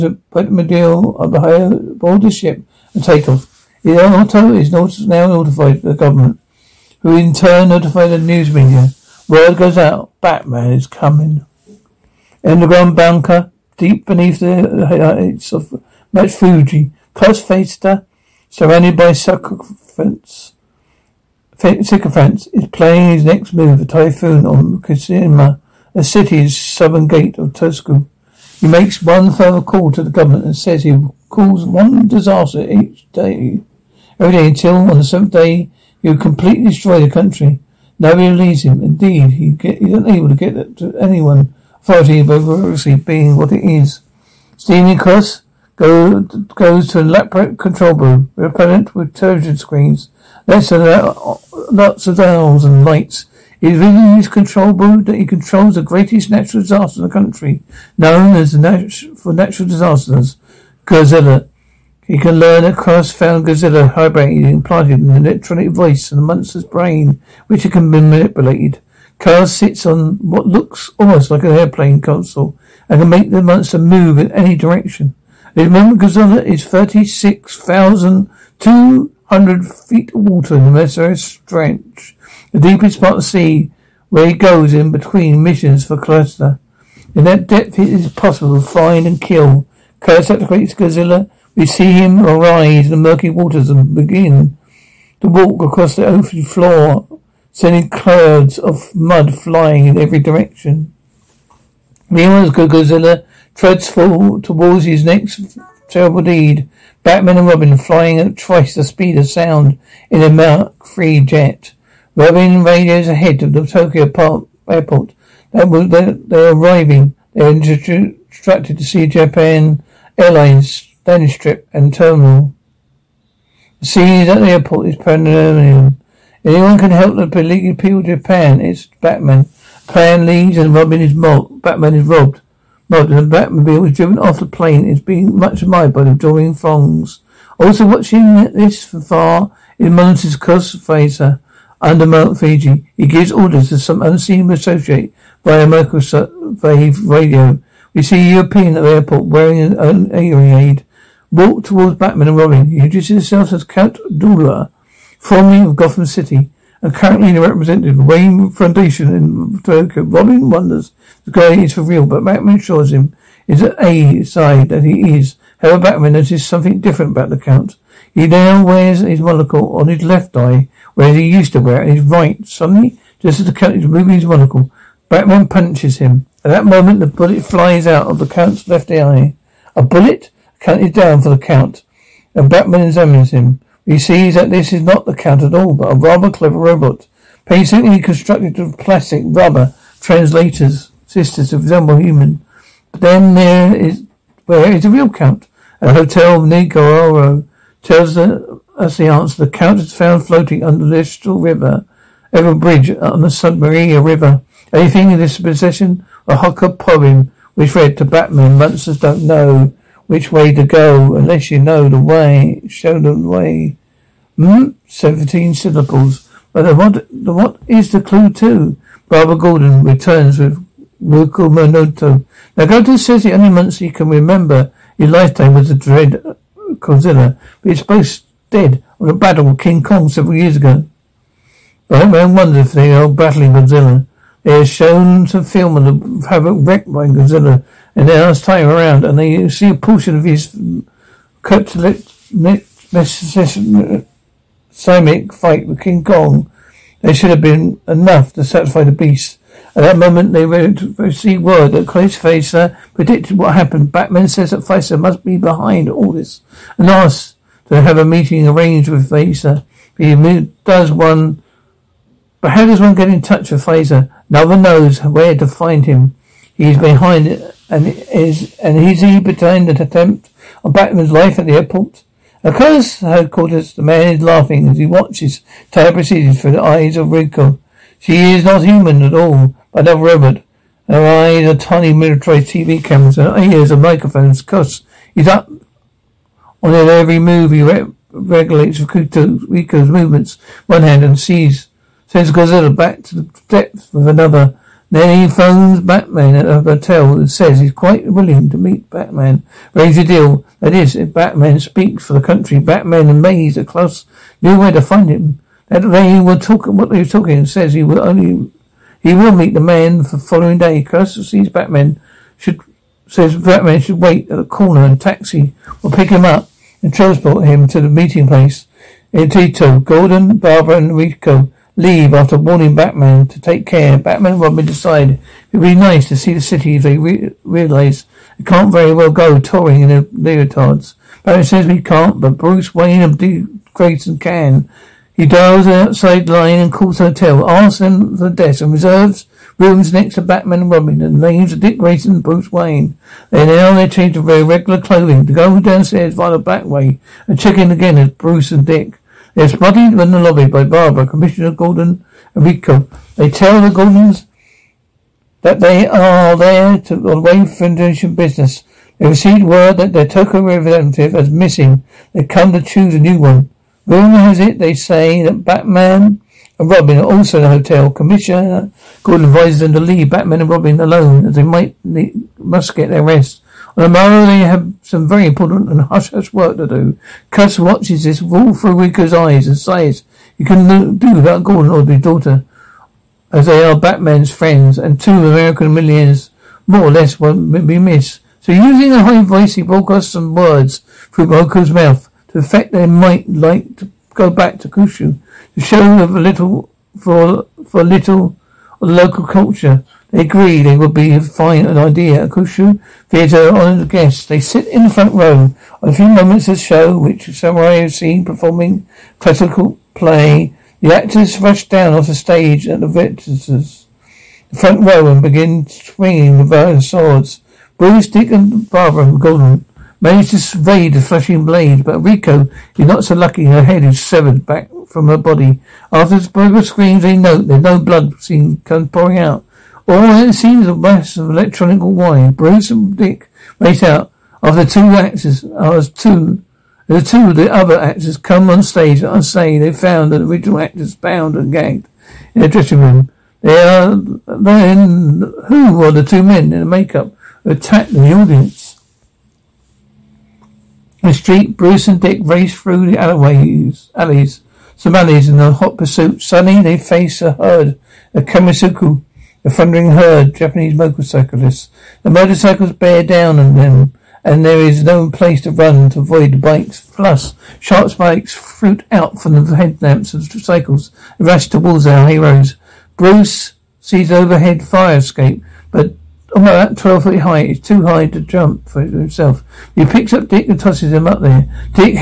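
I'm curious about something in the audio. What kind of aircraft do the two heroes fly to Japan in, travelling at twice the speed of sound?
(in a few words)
Mark 3 jet.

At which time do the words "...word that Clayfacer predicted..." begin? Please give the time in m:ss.
4:11.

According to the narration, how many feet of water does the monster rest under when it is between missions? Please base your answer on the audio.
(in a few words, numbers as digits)
36,200.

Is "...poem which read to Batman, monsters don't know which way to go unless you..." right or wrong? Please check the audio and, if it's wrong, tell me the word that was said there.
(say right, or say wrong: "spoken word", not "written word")
right.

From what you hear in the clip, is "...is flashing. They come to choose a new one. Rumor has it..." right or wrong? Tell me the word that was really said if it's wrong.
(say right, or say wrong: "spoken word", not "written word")
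wrong: "missing", not "flashing".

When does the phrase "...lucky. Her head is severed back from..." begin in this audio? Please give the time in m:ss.
7:03.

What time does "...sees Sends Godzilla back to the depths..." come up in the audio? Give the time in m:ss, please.
4:51.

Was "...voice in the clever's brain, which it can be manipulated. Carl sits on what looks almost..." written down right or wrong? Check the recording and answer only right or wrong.
wrong.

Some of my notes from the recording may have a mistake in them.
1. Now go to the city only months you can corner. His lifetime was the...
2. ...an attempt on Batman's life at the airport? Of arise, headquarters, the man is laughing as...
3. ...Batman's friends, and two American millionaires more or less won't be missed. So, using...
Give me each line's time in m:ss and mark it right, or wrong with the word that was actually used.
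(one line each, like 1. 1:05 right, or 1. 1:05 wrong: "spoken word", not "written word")
1. 3:42 wrong: "remember", not "corner"
2. 4:29 wrong: "course", not "arise"
3. 6:23 right.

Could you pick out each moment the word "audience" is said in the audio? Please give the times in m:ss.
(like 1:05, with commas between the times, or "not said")
7:28.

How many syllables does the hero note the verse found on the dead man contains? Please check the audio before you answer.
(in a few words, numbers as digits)
17.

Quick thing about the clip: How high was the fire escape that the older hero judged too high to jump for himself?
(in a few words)
12 feet.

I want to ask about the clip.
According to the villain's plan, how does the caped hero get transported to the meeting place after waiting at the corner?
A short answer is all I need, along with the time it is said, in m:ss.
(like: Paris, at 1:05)
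taxi, at 5:15.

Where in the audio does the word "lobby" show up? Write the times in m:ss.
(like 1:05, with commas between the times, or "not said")
5:50.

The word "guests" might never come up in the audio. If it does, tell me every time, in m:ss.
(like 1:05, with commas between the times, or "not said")
6:43.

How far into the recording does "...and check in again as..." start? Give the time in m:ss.
5:47.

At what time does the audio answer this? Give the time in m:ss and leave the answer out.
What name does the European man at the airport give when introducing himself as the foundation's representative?
2:33.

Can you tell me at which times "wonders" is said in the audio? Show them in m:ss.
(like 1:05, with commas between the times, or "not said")
2:40, 3:52.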